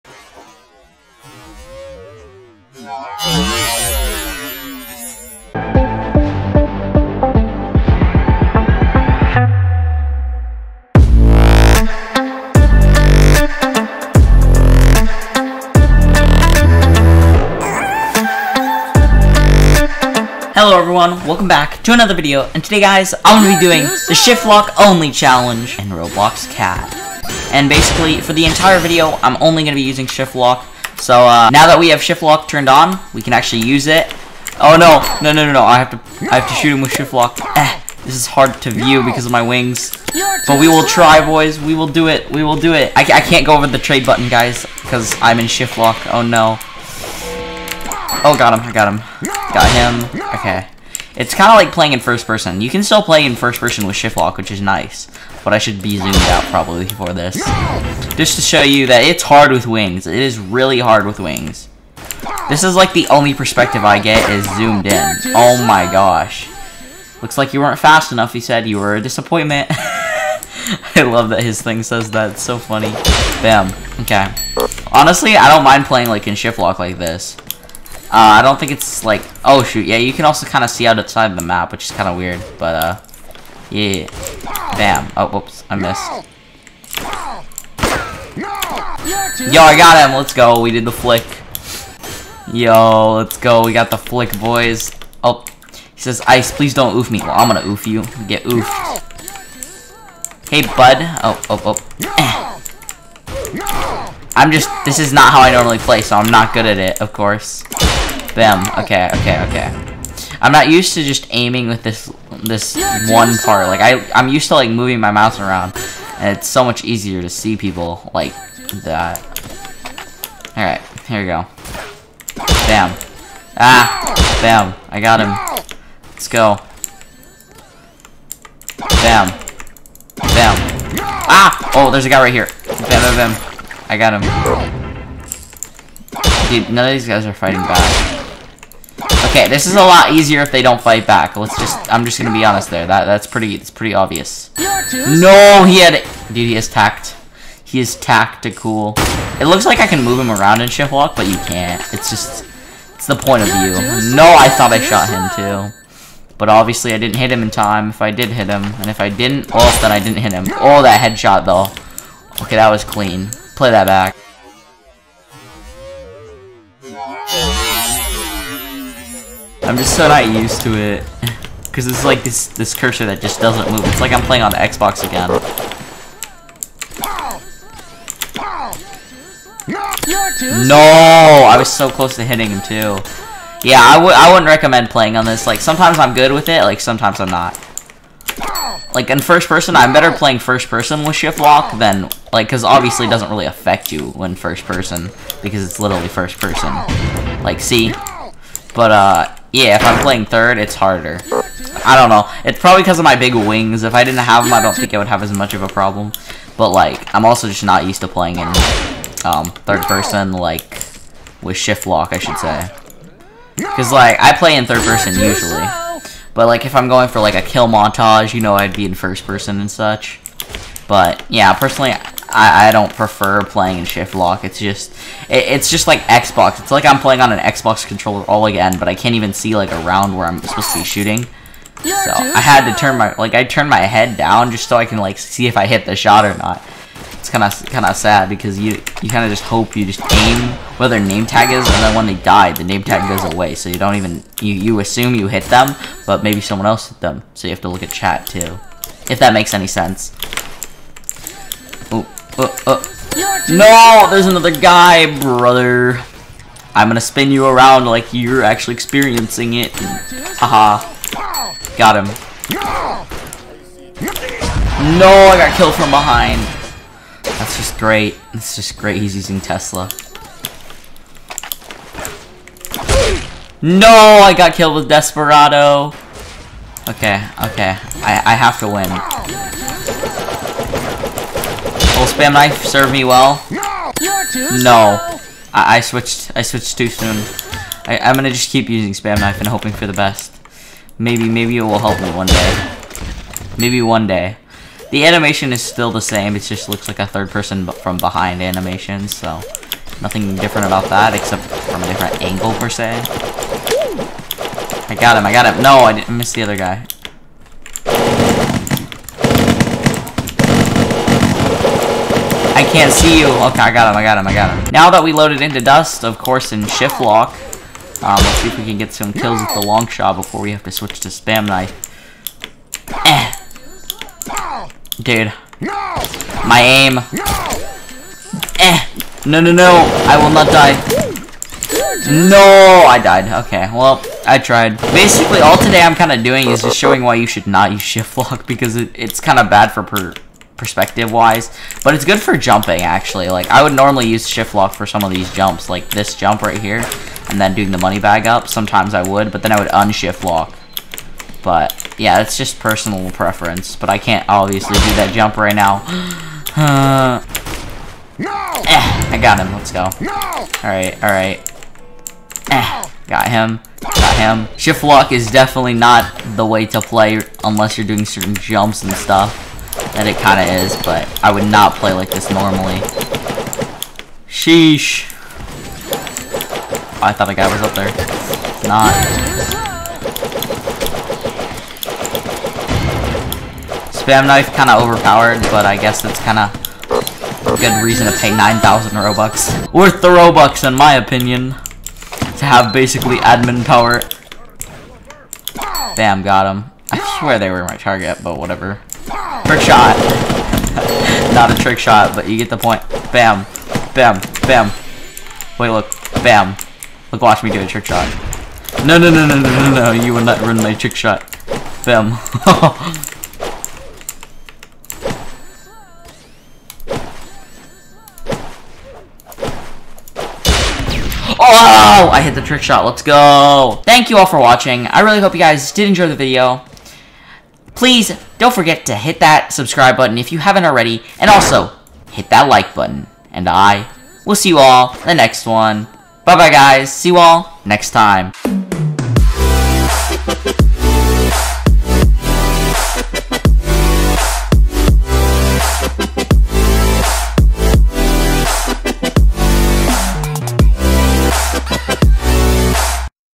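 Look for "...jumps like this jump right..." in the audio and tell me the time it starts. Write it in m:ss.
5:45.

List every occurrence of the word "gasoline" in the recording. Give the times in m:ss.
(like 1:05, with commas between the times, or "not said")
not said.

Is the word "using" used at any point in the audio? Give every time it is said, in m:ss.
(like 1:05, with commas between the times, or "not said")
0:29, 4:29, 4:48.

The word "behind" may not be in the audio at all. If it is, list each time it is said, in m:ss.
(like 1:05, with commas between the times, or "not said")
4:25, 4:57.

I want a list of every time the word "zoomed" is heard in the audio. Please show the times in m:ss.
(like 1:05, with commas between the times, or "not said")
0:55, 1:04.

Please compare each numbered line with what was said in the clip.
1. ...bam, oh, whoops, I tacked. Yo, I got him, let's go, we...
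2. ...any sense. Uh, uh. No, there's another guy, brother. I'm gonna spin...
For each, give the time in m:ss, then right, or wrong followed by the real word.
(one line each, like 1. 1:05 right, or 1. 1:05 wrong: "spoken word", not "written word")
1. 1:24 wrong: "missed", not "tacked"
2. 4:09 right.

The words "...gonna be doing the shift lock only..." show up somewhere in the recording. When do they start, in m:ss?
0:23.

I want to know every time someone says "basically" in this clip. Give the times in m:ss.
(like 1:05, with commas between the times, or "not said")
0:27, 5:34, 6:32.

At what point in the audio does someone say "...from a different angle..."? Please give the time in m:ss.
5:01.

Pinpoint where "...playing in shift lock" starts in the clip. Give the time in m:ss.
3:43.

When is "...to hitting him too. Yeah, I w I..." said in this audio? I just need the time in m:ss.
3:02.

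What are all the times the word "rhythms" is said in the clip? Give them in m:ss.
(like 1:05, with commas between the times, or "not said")
not said.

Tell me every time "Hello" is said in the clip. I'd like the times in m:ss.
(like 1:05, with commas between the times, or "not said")
0:20.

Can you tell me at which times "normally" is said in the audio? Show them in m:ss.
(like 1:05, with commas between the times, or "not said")
1:45, 5:43, 6:12.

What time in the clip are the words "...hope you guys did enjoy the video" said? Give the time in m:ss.
7:05.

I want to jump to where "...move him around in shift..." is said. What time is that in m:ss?
2:30.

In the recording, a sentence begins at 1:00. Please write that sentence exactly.
It is really hard with wings.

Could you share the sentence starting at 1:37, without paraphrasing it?
Well, I'm gonna oof you, get oofed.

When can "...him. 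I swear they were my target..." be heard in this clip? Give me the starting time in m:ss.
6:36.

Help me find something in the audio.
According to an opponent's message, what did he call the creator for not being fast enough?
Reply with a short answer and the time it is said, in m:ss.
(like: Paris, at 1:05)
A disappointment, at 1:08.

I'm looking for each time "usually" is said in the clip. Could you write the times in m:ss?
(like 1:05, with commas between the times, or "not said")
3:35.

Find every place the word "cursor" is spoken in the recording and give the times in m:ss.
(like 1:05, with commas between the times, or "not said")
2:52.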